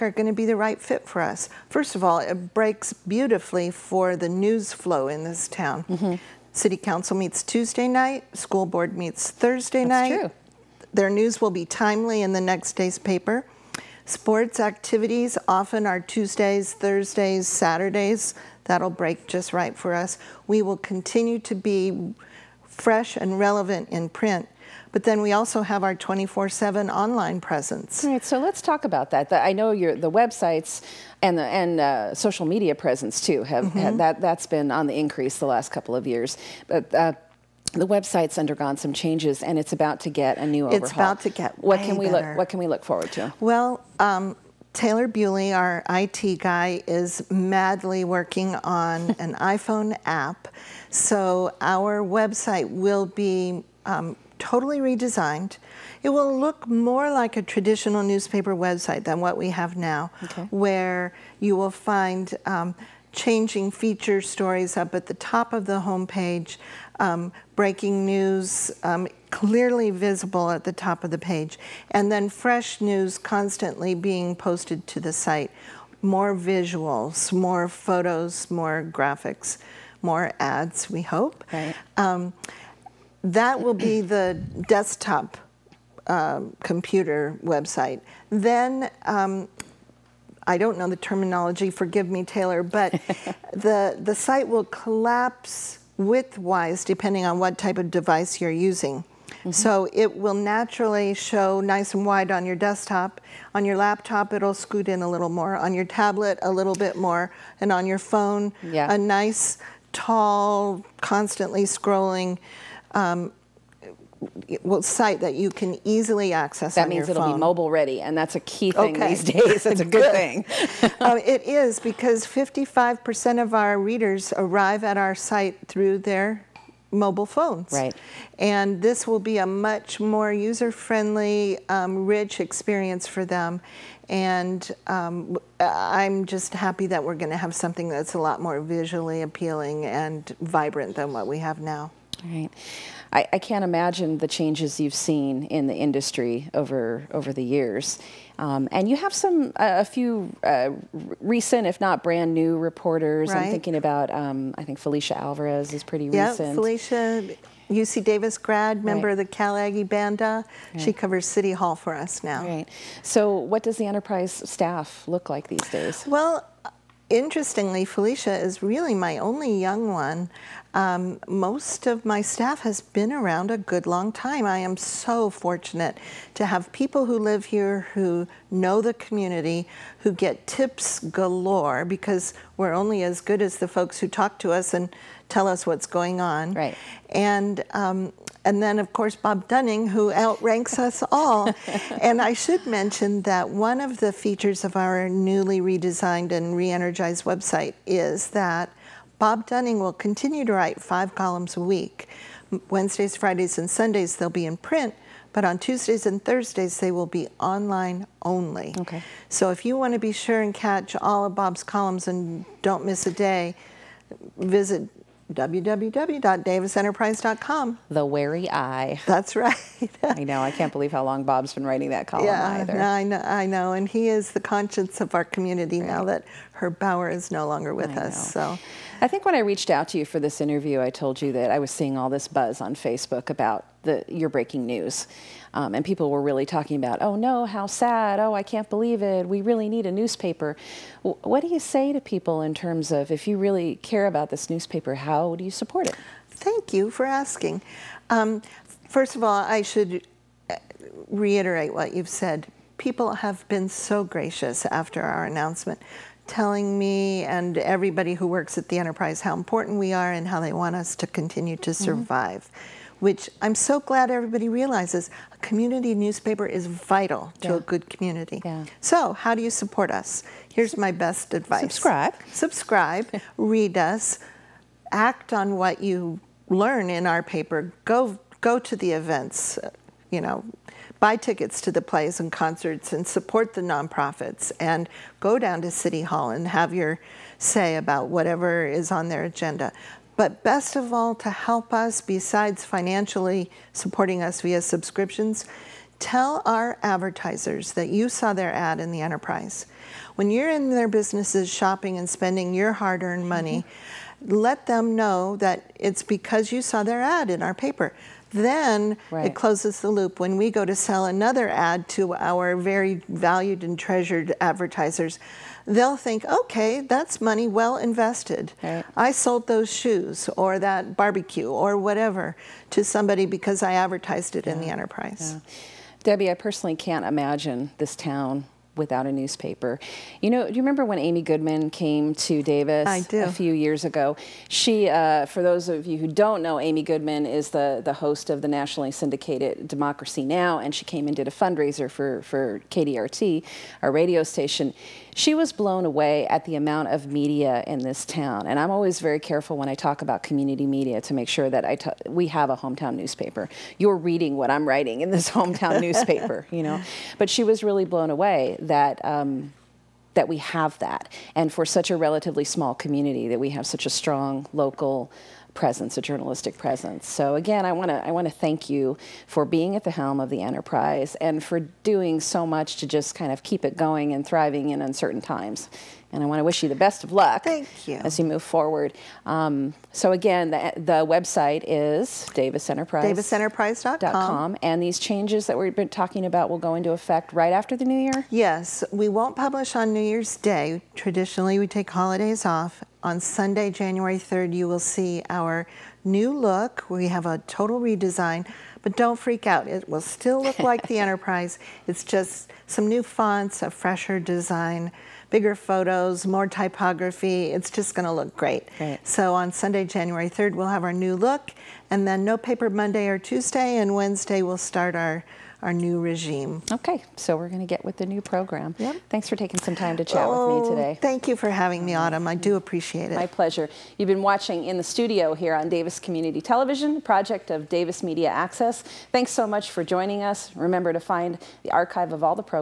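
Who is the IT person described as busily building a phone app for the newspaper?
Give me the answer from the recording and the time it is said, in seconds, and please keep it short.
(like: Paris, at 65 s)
Taylor Bewley, at 44 s.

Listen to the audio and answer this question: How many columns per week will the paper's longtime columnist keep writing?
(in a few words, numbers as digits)
5.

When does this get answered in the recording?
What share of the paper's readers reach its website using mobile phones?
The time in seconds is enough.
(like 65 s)
122 s.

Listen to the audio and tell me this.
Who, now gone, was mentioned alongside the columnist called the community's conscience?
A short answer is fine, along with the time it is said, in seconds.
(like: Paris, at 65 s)
Herb Bauer, at 226 s.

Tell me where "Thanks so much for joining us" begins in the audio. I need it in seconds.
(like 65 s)
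429 s.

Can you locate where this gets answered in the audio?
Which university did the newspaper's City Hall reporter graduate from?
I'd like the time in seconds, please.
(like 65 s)
157 s.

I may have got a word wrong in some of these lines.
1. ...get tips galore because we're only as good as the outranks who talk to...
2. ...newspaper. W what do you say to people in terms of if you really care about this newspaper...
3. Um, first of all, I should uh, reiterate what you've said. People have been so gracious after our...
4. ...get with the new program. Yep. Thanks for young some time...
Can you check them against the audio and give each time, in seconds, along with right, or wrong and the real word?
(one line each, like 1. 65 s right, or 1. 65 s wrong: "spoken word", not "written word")
1. 180 s wrong: "folks", not "outranks"
2. 239 s right
3. 248 s right
4. 417 s wrong: "taking", not "young".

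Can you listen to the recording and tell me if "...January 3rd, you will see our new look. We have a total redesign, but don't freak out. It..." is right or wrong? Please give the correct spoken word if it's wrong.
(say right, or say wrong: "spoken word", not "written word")
right.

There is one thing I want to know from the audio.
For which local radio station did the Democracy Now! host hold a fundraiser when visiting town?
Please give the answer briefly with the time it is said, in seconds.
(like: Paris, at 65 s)
KDRT, at 342 s.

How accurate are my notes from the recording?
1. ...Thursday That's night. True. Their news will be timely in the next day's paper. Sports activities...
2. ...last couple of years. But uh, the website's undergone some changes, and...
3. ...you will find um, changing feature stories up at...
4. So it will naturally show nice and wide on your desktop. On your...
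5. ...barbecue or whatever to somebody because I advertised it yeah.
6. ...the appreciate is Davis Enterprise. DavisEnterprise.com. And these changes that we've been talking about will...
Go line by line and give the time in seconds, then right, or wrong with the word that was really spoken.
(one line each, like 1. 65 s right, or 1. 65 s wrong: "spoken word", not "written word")
1. 9 s right
2. 35 s right
3. 61 s right
4. 99 s right
5. 320 s right
6. 380 s wrong: "website", not "appreciate".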